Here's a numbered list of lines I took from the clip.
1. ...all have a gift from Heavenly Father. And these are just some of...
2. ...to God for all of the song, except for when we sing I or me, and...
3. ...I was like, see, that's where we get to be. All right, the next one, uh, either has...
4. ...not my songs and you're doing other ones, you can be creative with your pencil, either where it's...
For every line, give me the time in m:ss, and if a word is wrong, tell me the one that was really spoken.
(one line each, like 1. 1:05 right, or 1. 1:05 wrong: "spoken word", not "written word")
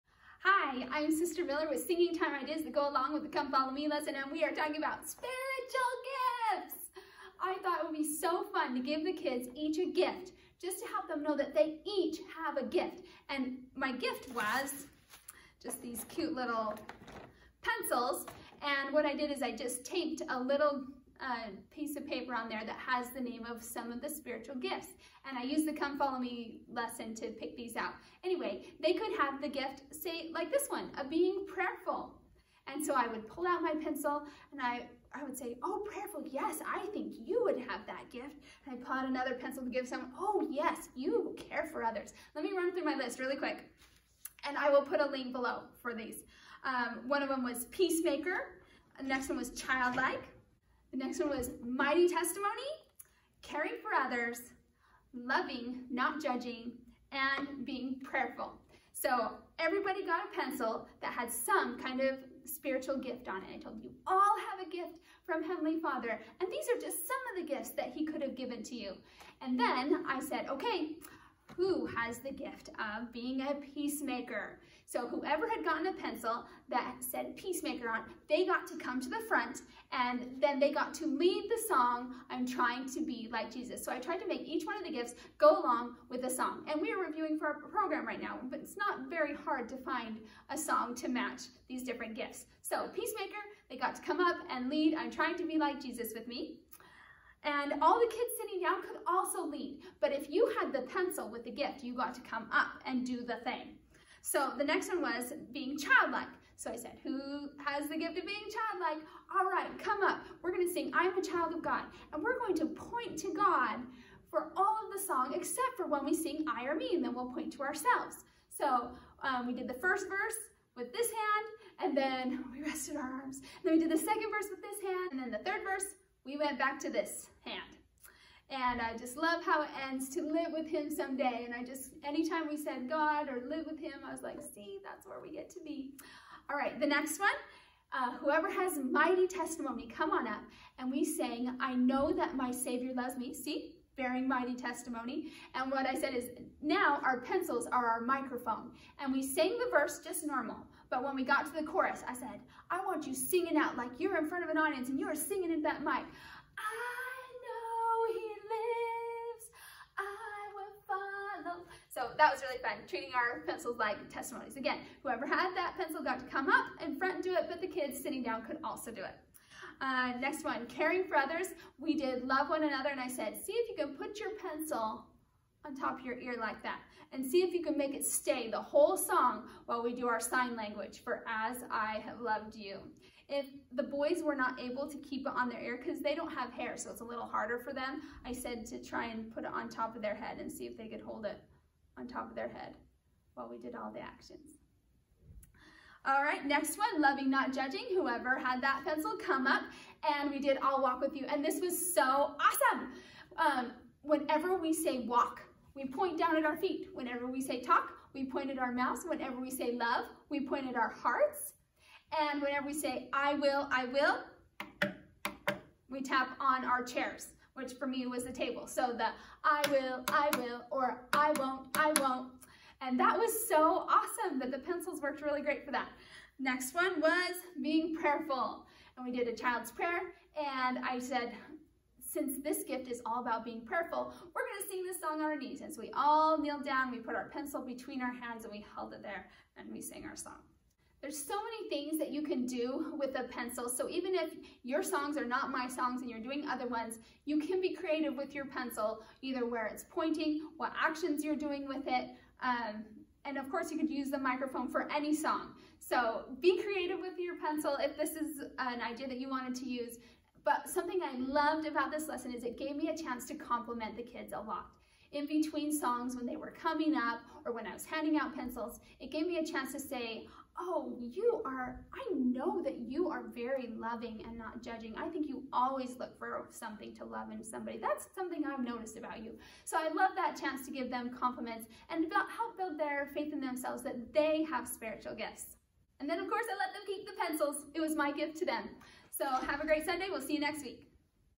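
1. 1:04 right
2. 1:53 right
3. 2:14 wrong: "whoever", not "either"
4. 4:05 right.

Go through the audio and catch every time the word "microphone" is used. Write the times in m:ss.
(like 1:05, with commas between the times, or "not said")
2:28, 4:14.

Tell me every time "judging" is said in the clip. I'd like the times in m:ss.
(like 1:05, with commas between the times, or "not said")
0:56, 3:17, 4:34.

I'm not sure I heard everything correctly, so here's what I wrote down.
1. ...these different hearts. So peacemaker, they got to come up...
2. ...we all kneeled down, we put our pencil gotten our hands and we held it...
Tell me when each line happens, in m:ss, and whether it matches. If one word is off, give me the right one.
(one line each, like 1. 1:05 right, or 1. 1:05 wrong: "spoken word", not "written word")
1. 1:31 wrong: "gifts", not "hearts"
2. 3:55 wrong: "between", not "gotten".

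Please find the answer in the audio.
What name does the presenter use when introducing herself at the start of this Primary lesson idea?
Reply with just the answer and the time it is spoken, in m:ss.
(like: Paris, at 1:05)
Sister Miller, at 0:01.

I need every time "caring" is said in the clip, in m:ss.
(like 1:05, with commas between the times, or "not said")
0:53, 2:50.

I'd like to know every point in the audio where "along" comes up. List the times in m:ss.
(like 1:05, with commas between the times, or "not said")
0:02, 1:25.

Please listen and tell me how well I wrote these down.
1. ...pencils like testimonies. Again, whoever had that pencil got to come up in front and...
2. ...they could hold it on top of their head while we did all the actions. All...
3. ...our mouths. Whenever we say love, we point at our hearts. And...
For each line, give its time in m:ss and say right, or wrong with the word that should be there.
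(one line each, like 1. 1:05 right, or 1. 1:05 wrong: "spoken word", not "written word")
1. 2:43 right
2. 3:10 right
3. 3:28 right.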